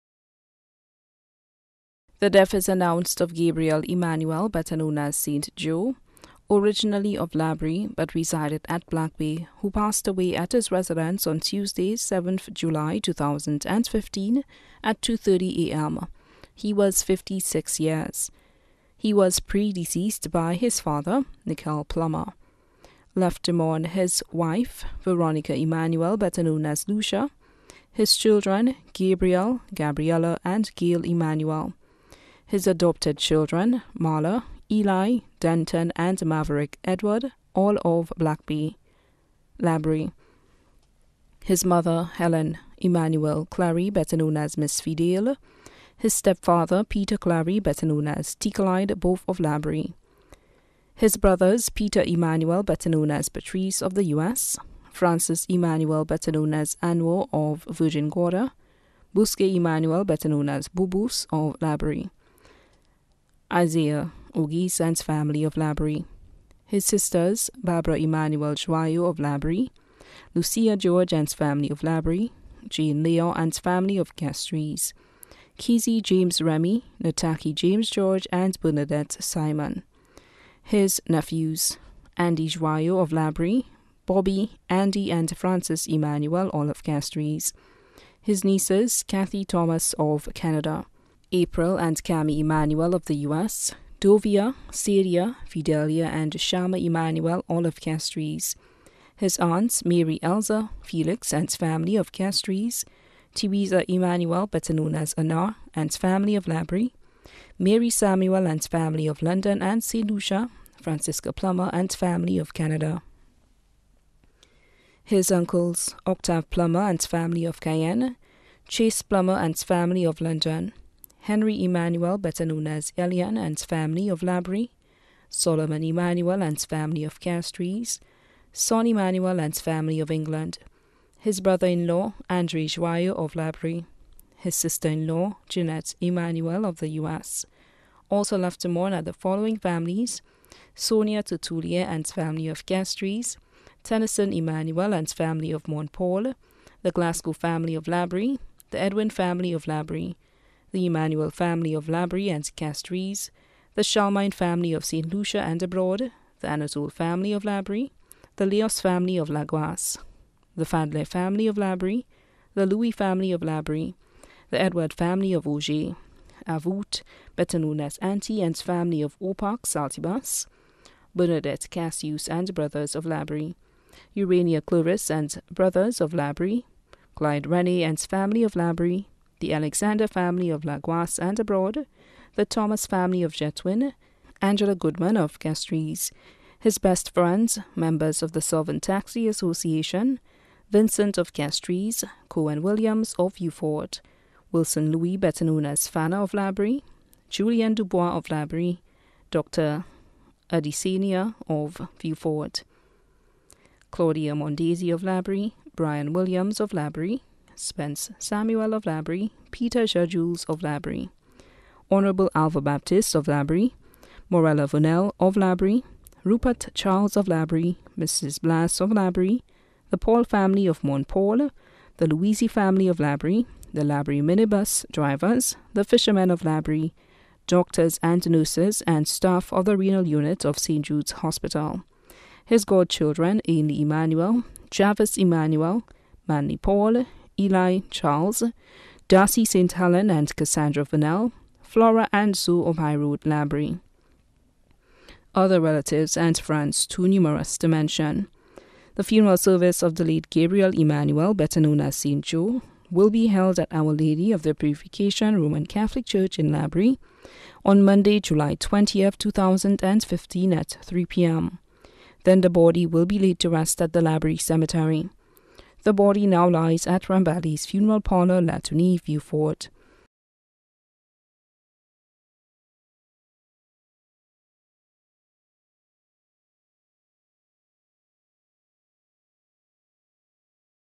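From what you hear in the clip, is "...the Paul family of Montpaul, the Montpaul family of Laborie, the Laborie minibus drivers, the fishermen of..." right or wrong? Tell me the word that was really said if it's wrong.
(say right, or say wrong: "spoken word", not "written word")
wrong: "Louisi", not "Montpaul".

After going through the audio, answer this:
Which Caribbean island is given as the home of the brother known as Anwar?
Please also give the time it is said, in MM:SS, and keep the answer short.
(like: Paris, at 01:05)
Virgin Gorda, at 00:57.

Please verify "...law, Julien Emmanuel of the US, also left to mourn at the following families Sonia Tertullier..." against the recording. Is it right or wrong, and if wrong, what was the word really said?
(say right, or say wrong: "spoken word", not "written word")
wrong: "Jeanette", not "Julien".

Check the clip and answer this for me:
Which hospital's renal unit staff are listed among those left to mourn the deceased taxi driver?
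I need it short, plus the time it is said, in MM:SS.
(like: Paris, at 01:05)
St. Jude's Hospital, at 03:50.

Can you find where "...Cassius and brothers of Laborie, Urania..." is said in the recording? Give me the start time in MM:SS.
02:51.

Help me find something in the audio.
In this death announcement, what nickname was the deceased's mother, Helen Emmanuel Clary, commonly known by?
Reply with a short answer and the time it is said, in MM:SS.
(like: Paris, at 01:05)
Miss Fidel, at 00:44.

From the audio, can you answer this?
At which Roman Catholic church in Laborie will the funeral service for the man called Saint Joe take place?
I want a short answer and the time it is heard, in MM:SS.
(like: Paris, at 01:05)
Our Lady of the Purification, at 04:13.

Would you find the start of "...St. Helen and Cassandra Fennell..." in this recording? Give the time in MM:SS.
03:59.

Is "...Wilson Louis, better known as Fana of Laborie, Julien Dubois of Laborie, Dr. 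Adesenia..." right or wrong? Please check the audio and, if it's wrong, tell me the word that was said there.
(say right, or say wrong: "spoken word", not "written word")
right.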